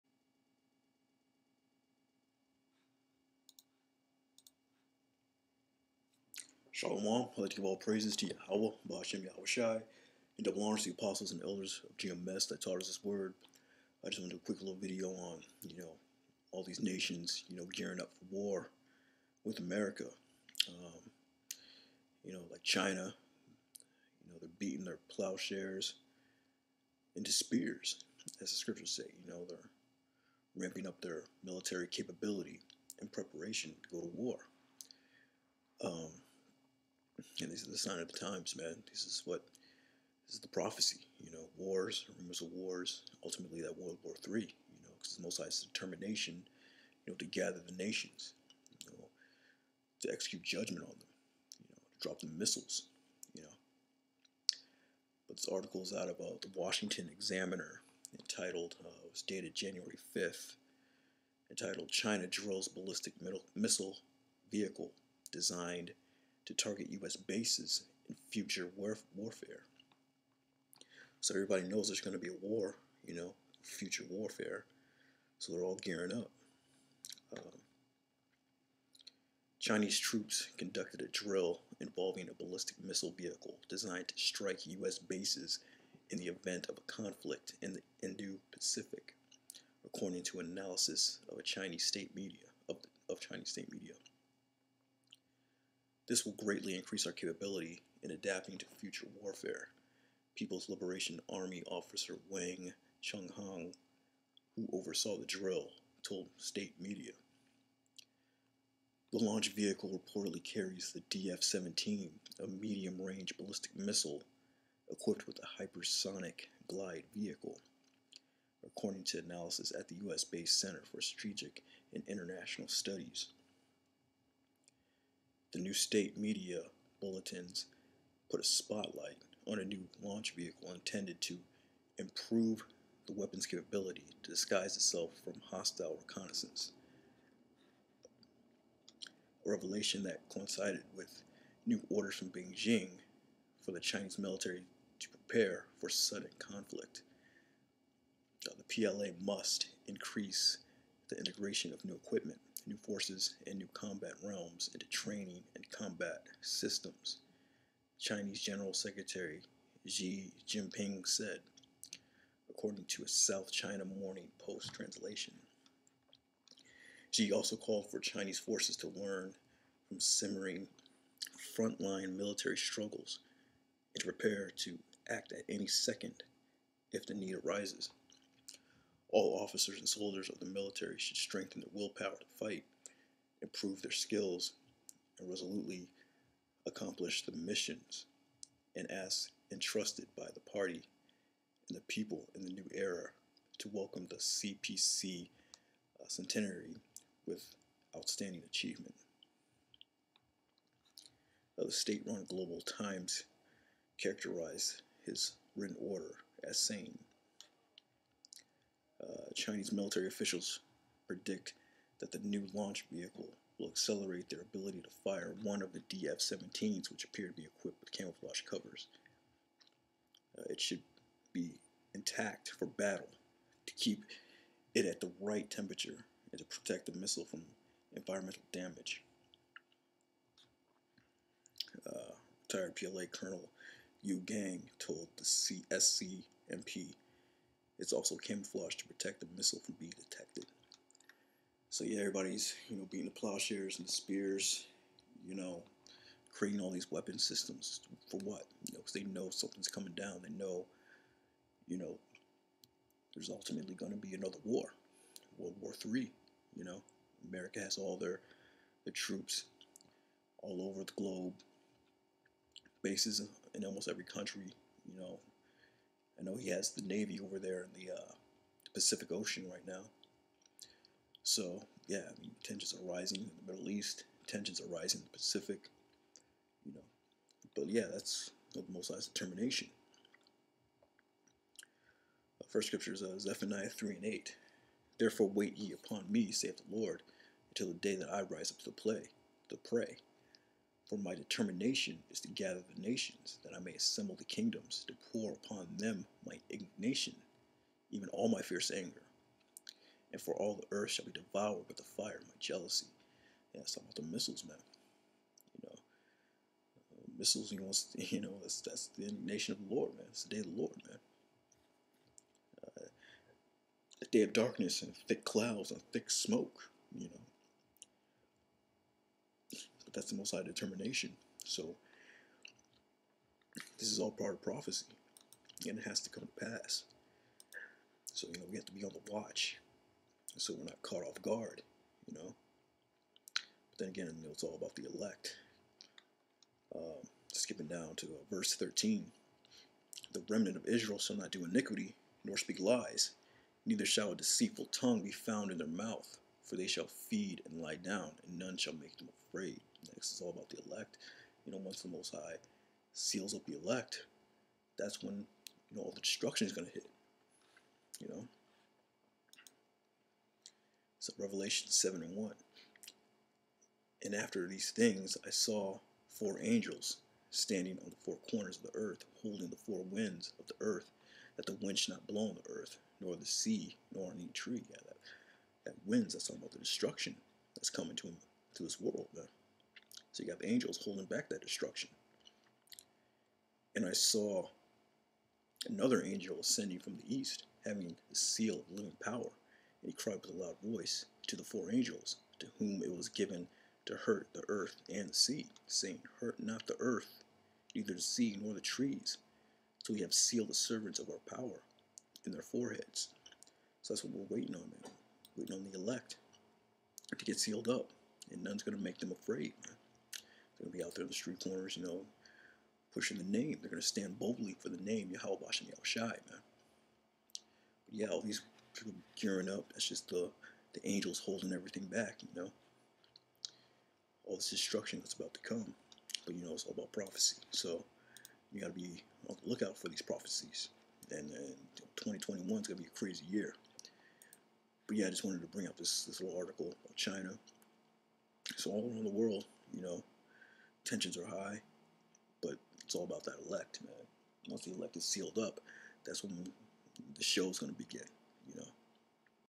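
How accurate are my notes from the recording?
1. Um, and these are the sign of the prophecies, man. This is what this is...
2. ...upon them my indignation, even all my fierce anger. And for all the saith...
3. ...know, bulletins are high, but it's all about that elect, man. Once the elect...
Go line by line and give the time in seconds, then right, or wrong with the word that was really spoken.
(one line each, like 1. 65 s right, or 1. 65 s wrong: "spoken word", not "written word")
1. 35 s wrong: "times", not "prophecies"
2. 295 s wrong: "earth", not "saith"
3. 439 s wrong: "tensions", not "bulletins".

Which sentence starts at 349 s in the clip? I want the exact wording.
Next is all about the elect.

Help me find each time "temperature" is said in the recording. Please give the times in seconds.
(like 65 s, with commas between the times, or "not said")
225 s.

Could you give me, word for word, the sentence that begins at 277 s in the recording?
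But yeah, that's the Most High's determination.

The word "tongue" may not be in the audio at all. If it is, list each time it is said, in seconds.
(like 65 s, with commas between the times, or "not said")
344 s.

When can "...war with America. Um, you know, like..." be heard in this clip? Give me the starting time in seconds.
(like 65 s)
18 s.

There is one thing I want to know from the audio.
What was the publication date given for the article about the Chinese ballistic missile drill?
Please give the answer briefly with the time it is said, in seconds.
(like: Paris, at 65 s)
January 5th, at 59 s.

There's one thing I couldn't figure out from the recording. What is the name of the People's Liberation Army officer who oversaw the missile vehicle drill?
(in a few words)
Wang Chenghong.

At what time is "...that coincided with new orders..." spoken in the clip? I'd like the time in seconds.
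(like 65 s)
140 s.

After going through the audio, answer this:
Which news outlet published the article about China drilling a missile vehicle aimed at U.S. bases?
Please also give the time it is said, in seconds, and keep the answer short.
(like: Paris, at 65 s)
Washington Examiner, at 56 s.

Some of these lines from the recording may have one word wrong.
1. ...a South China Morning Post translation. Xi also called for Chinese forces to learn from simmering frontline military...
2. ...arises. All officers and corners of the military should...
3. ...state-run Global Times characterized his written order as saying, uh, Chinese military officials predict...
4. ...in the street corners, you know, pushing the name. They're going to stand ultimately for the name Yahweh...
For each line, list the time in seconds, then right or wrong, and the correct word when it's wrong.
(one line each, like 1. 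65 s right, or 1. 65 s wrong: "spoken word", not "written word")
1. 163 s right
2. 177 s wrong: "soldiers", not "corners"
3. 201 s right
4. 411 s wrong: "boldly", not "ultimately".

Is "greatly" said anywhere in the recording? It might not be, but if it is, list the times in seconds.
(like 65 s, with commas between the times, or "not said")
96 s.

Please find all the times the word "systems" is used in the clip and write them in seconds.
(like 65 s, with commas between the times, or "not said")
156 s, 247 s.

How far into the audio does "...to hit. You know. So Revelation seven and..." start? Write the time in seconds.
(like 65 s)
356 s.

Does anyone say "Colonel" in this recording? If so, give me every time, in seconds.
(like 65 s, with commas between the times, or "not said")
233 s.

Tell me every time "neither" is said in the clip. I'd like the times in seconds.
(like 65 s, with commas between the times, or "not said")
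343 s, 397 s.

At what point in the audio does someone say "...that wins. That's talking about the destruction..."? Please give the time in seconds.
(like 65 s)
375 s.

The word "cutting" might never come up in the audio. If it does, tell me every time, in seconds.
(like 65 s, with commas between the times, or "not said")
not said.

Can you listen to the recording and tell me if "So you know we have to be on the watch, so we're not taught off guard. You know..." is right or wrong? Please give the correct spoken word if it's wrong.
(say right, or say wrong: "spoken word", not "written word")
wrong: "caught", not "taught".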